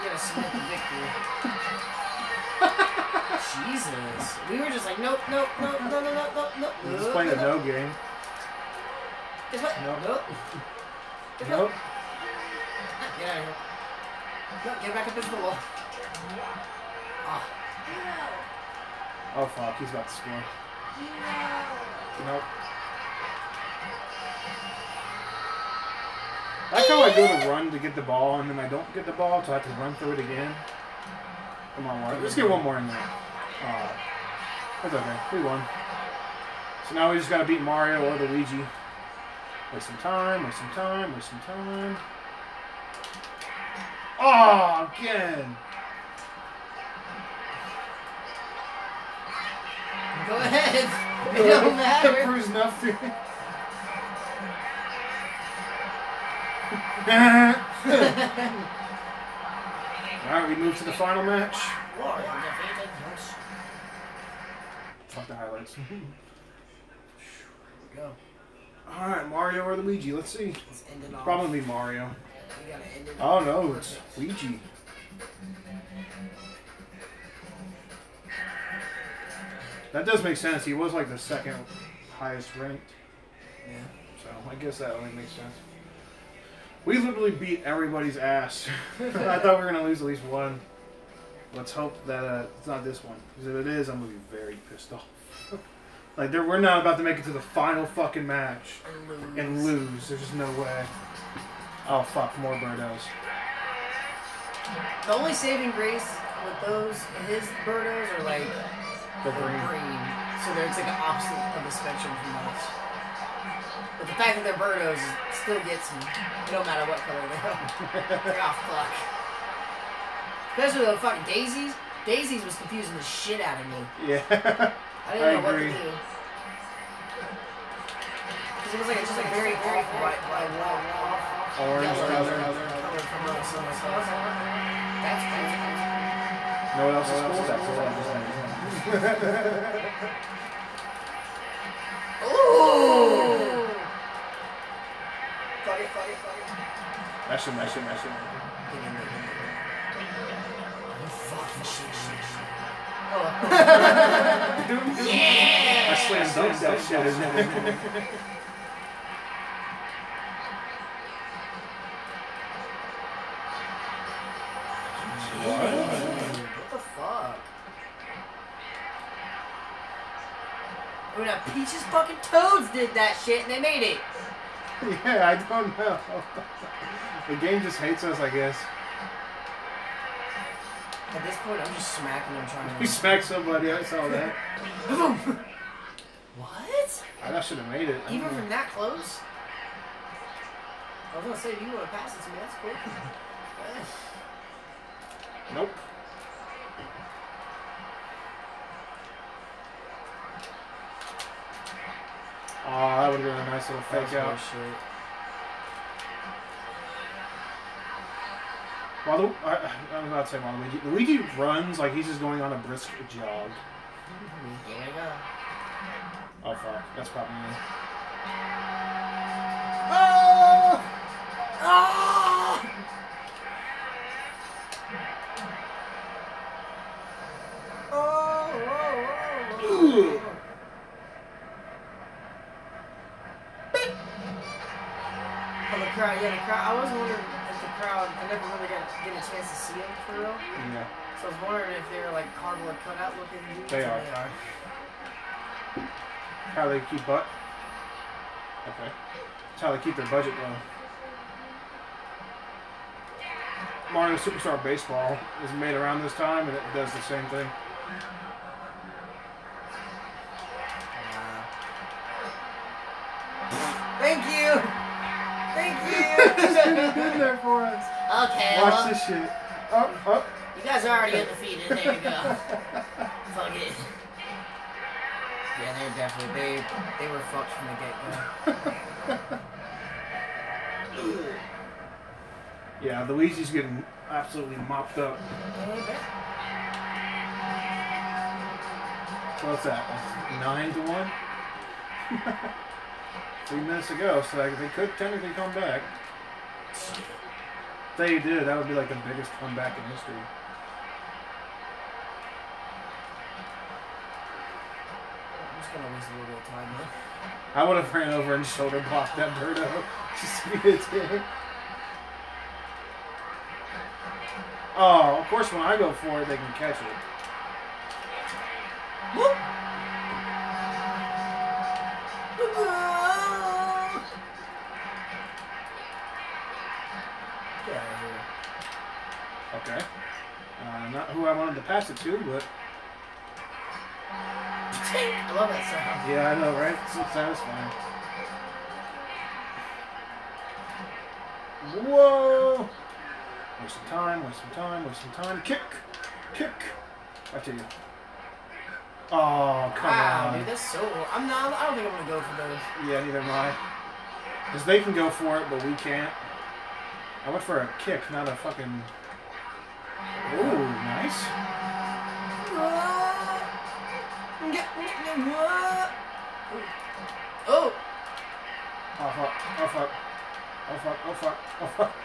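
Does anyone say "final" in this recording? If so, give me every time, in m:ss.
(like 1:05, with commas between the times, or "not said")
1:00, 1:37.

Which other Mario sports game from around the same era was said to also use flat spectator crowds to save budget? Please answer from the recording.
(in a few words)
Mario Superstar Baseball.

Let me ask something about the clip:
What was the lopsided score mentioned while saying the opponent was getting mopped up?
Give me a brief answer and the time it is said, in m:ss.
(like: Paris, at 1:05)
9 to 1, at 4:50.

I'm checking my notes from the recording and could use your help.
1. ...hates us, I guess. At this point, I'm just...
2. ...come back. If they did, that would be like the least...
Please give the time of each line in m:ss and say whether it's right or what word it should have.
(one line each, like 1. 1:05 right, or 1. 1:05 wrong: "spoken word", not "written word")
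1. 2:57 right
2. 4:55 wrong: "biggest", not "least".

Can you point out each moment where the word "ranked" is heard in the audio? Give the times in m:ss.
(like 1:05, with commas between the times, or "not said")
1:22.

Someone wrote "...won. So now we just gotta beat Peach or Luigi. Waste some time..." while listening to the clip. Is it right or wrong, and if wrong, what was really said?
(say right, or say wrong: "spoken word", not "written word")
wrong: "Mario", not "Peach".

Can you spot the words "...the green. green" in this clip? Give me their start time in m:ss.
1:49.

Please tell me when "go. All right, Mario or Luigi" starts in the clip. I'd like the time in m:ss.
1:07.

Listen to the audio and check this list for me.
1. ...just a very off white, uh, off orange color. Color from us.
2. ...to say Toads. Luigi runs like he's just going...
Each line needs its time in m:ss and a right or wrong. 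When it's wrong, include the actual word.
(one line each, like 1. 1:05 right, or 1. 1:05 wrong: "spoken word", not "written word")
1. 2:09 right
2. 3:30 wrong: "Waluigi", not "Toads".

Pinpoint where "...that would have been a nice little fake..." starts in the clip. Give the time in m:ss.
3:22.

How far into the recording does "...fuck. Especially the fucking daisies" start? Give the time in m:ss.
1:58.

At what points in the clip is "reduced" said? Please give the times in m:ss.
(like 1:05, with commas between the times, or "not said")
not said.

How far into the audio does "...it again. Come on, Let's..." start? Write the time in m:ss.
0:30.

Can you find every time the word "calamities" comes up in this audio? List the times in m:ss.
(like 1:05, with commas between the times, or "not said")
not said.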